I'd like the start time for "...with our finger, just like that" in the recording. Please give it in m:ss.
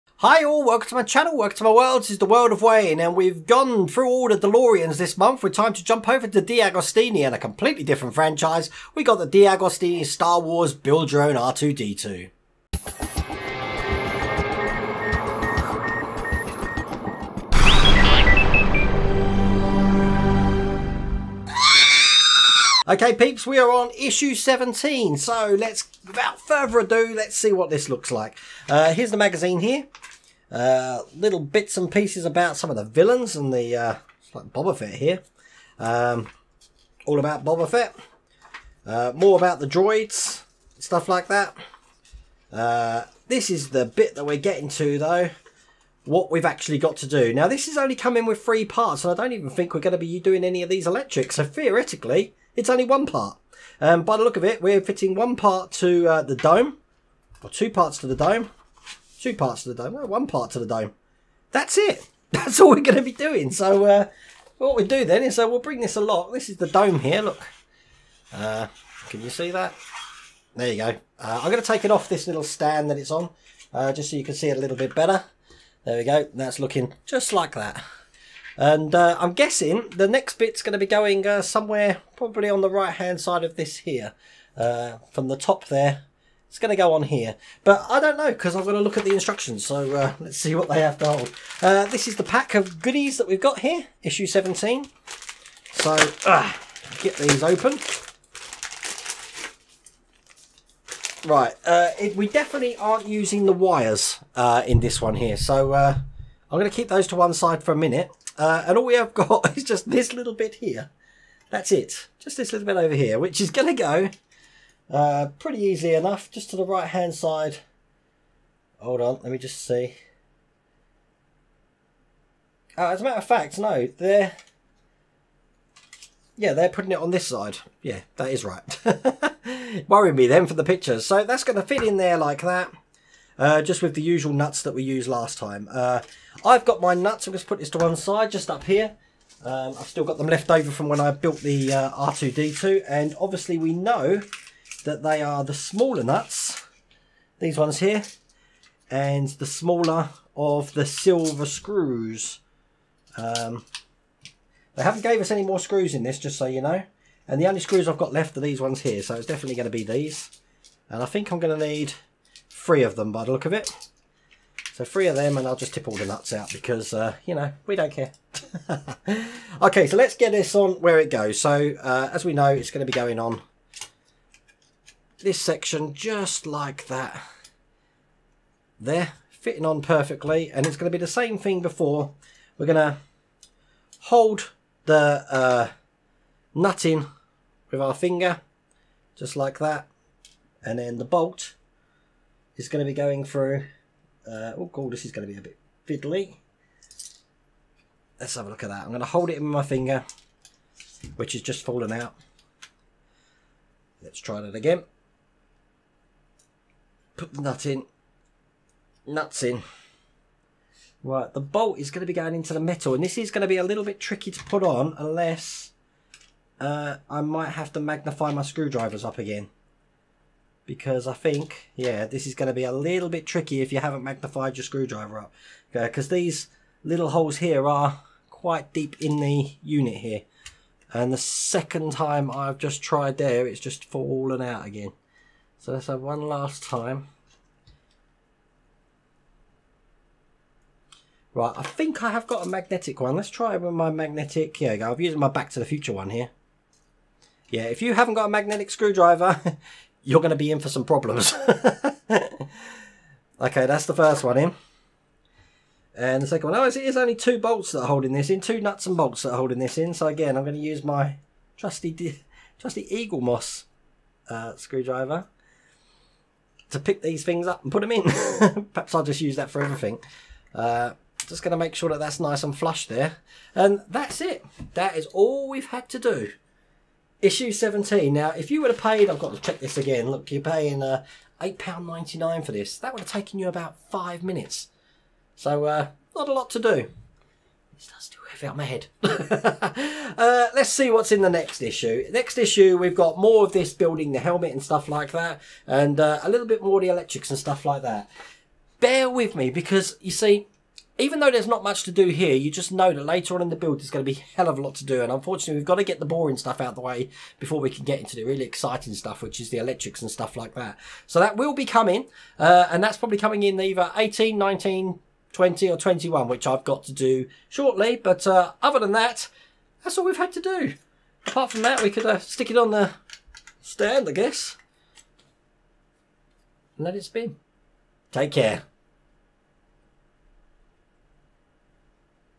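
3:07.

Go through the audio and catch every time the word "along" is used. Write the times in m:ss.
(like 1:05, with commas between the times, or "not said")
1:05.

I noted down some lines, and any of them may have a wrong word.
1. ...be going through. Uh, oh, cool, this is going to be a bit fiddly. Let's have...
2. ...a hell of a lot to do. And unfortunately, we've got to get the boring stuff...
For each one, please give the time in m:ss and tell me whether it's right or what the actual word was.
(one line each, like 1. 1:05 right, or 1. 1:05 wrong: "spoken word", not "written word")
1. 3:12 right
2. 5:04 right.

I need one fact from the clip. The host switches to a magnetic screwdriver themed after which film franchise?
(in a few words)
Back to the Future.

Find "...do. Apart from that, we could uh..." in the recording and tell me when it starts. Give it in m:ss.
5:20.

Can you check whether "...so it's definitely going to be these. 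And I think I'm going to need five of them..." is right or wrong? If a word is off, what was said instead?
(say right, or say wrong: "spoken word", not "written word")
wrong: "three", not "five".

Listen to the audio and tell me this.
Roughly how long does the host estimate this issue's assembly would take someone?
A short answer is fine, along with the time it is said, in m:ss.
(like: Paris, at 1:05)
about five minutes, at 4:43.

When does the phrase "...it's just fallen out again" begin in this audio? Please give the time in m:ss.
3:53.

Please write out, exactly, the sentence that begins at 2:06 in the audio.
Yeah, they're putting it on this side.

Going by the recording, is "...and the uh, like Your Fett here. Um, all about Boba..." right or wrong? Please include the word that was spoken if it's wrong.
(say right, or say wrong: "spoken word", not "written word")
wrong: "Boba", not "Your".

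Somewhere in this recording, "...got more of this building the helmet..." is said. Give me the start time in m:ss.
4:52.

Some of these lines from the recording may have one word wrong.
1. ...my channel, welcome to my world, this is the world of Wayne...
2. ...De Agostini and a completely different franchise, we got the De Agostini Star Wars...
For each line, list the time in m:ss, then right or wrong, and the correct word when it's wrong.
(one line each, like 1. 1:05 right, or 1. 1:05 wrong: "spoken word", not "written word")
1. 0:00 right
2. 0:06 right.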